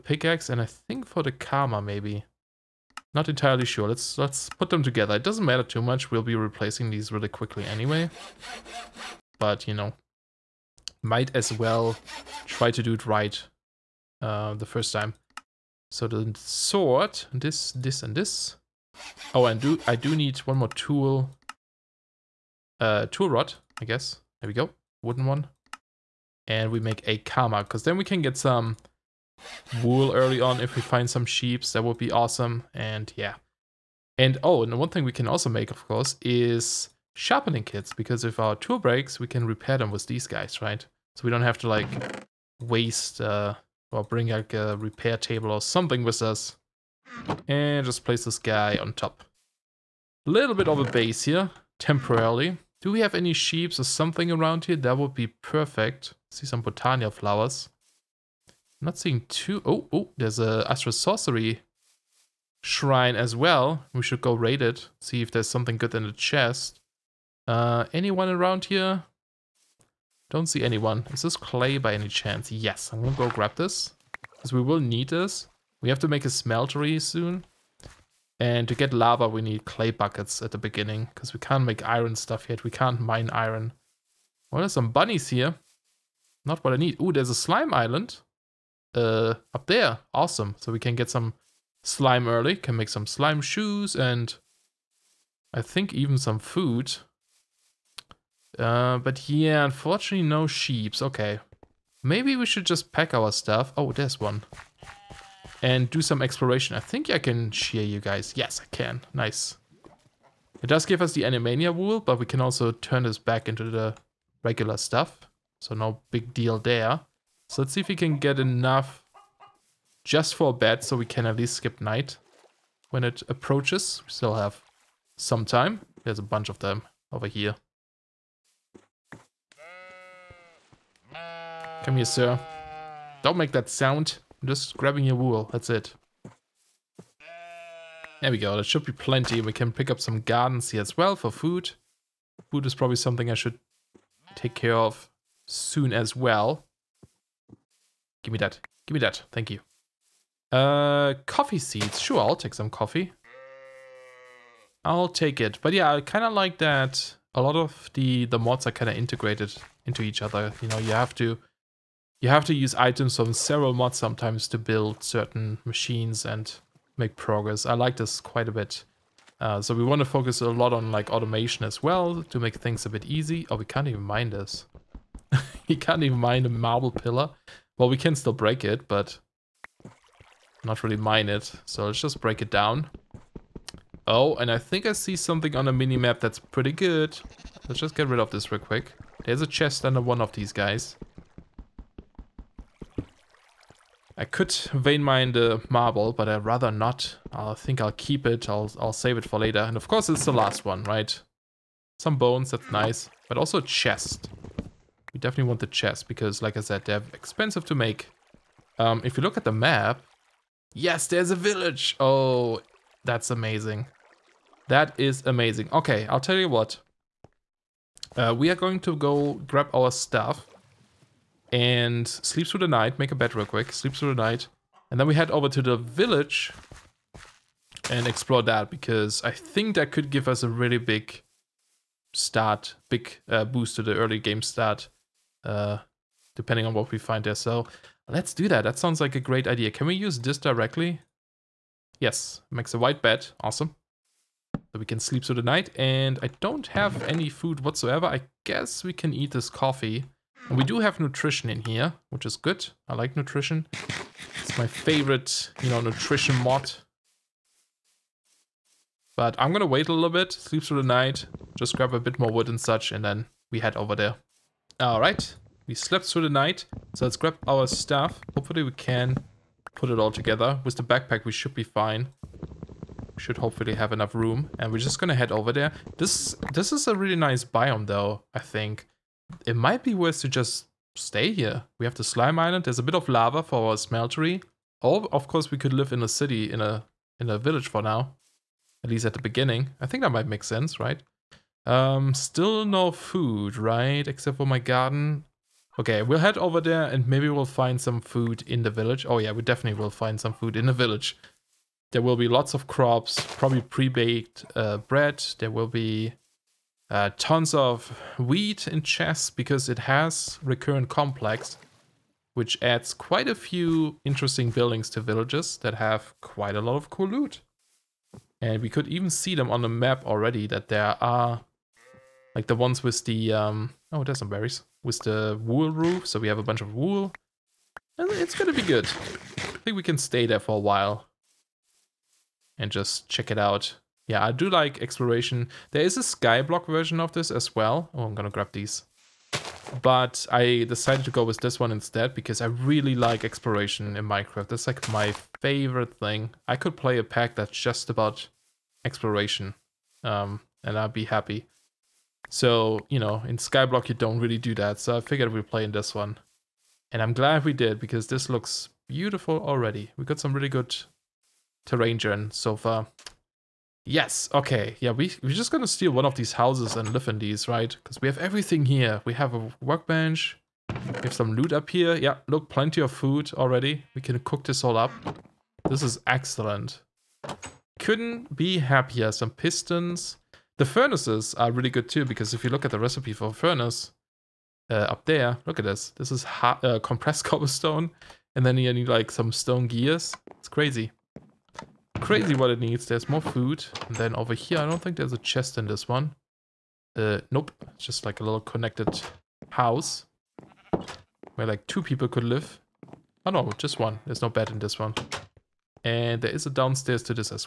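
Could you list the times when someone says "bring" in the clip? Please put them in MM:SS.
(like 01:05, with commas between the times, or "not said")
00:44.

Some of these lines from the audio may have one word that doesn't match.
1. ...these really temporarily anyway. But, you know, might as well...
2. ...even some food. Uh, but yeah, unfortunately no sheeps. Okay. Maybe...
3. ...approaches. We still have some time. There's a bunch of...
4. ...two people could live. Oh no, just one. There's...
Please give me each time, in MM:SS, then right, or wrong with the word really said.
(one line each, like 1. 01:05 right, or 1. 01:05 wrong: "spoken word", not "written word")
1. 00:06 wrong: "quickly", not "temporarily"
2. 01:35 right
3. 02:03 right
4. 06:41 right.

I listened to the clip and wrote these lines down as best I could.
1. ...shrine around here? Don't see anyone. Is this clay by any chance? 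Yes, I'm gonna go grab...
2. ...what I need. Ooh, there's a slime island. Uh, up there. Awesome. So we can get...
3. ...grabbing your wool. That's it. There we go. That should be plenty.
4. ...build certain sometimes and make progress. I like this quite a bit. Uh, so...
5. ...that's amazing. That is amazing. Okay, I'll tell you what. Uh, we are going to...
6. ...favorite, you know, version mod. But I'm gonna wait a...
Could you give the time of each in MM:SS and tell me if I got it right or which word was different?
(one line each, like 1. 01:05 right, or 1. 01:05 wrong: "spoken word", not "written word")
1. 01:07 wrong: "anyone", not "shrine"
2. 01:26 right
3. 02:14 right
4. 02:44 wrong: "machines", not "sometimes"
5. 03:33 right
6. 04:14 wrong: "nutrition", not "version".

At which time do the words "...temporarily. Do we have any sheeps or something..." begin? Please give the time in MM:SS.
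00:51.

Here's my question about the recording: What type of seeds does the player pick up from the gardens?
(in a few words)
Coffee seeds.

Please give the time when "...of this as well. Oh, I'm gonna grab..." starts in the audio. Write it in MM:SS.
05:36.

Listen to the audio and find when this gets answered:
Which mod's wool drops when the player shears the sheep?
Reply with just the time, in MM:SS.
01:51.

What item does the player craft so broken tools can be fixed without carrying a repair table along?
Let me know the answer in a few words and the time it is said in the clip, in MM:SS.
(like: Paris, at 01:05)
Sharpening kits, at 00:37.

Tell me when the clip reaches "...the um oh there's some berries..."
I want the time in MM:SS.
05:23.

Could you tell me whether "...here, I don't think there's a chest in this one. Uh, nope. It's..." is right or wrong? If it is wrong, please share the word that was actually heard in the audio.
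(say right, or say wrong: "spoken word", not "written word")
right.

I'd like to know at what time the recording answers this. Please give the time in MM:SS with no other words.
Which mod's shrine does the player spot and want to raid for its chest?
01:00.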